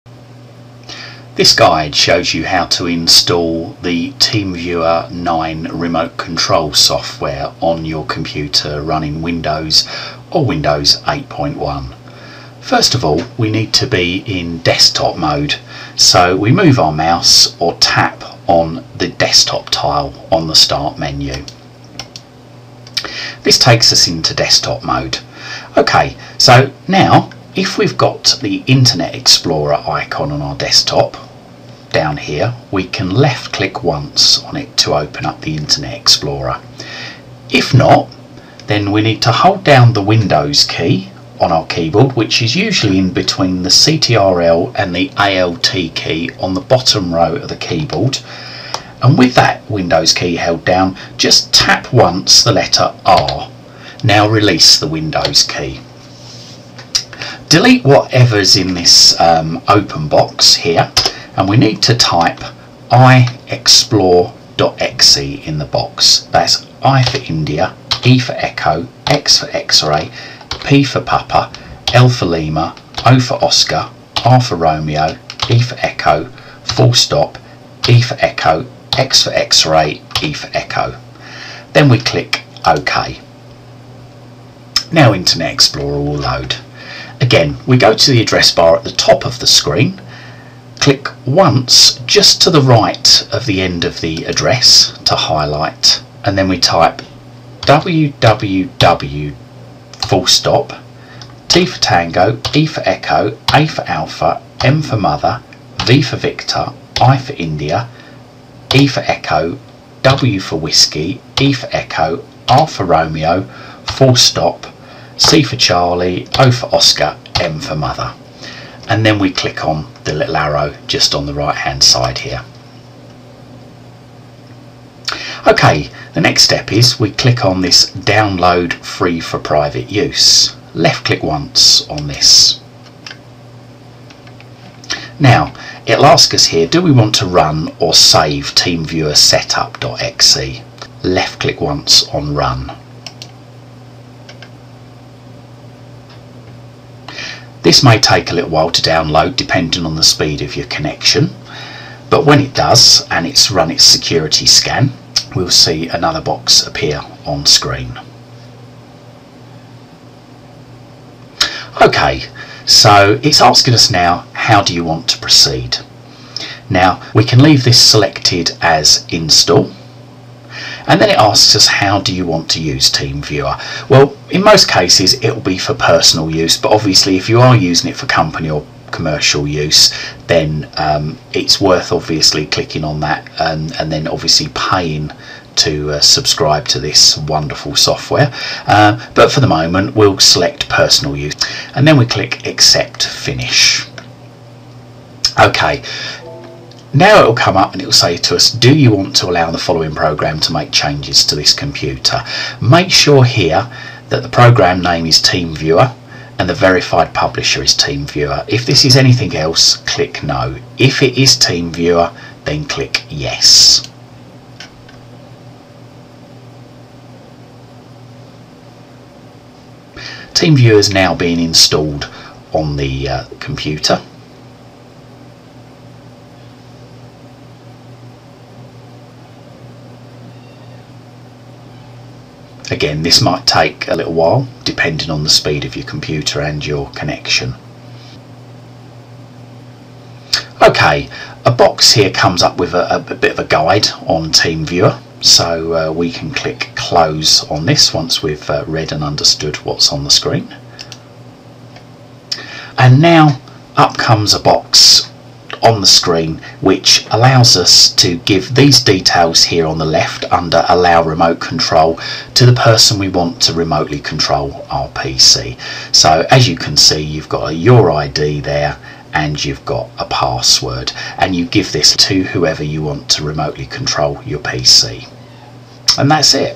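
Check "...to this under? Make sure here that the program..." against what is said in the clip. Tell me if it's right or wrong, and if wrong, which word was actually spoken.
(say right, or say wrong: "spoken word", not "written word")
wrong: "computer", not "under".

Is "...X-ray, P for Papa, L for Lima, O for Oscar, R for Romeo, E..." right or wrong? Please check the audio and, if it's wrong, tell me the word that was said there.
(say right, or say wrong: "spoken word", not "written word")
right.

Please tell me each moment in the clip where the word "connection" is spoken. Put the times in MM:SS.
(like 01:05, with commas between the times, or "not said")
02:30, 03:56.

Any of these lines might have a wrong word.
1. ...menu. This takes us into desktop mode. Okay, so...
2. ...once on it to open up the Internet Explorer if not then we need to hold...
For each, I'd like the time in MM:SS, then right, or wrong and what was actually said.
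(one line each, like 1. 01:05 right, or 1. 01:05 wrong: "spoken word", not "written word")
1. 00:20 right
2. 00:33 right.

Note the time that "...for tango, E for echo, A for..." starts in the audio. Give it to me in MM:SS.
01:41.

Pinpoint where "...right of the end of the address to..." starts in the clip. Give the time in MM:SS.
01:32.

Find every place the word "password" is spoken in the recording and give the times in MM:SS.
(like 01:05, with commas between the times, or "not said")
04:30.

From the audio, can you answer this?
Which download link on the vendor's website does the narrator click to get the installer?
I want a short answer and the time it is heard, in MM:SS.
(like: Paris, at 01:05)
download free for private use, at 02:07.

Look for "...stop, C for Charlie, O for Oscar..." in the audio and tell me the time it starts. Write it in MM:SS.
01:54.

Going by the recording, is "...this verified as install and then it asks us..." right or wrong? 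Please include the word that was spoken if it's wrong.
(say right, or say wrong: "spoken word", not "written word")
wrong: "selected", not "verified".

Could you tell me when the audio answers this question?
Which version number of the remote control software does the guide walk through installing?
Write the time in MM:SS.
00:04.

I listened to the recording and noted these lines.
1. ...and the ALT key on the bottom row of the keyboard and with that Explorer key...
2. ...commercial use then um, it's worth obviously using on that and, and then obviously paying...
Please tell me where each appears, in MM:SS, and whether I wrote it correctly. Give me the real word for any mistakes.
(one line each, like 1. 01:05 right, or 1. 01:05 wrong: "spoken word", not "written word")
1. 00:44 wrong: "Windows", not "Explorer"
2. 02:58 wrong: "clicking", not "using".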